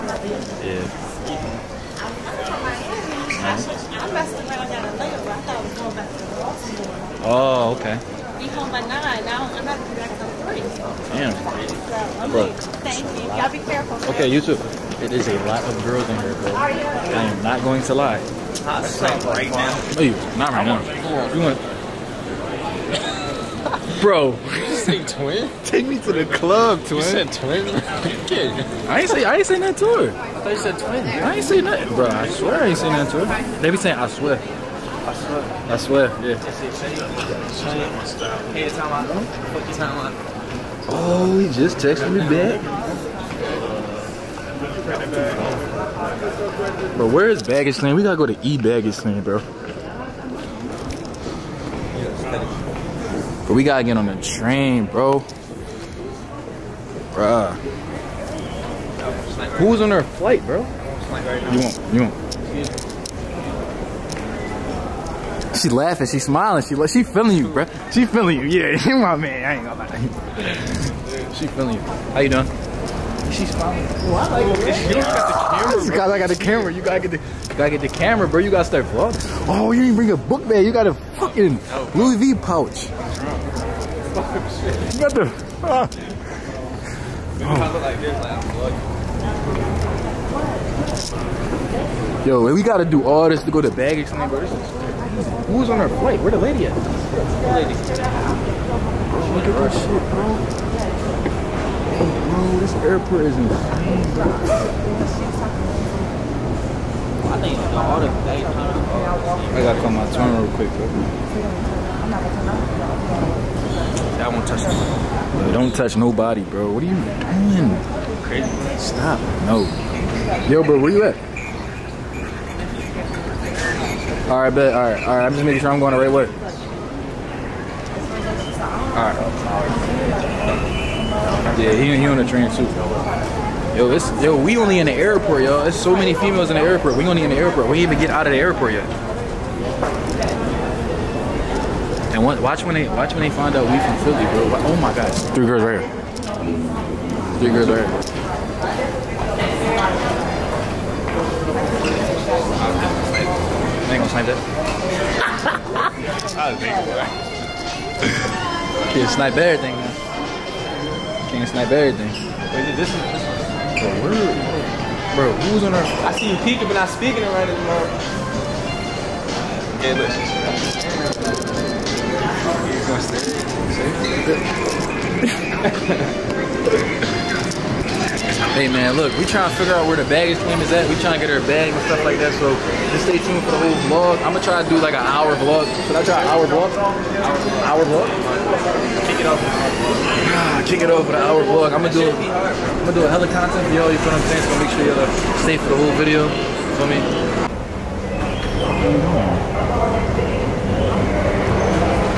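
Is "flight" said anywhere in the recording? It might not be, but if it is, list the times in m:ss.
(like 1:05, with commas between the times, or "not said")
1:00, 1:35.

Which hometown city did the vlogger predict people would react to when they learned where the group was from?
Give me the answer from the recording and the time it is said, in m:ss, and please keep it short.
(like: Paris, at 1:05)
Philly, at 2:24.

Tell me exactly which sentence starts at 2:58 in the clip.
hey man, look, we trying to figure out where the baggage claim is at.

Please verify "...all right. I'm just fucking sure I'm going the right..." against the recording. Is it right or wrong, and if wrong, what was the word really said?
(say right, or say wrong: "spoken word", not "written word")
wrong: "making", not "fucking".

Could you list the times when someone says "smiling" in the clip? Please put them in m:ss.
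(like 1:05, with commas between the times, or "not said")
1:06, 1:13.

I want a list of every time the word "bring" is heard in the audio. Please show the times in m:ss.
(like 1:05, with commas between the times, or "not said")
1:19.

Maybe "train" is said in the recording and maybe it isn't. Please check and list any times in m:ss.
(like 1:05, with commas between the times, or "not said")
0:54, 2:12.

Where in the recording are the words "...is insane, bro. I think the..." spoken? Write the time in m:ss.
1:43.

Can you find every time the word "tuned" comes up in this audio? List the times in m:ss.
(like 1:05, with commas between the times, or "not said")
3:03.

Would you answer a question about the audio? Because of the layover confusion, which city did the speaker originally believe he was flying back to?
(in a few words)
Baltimore.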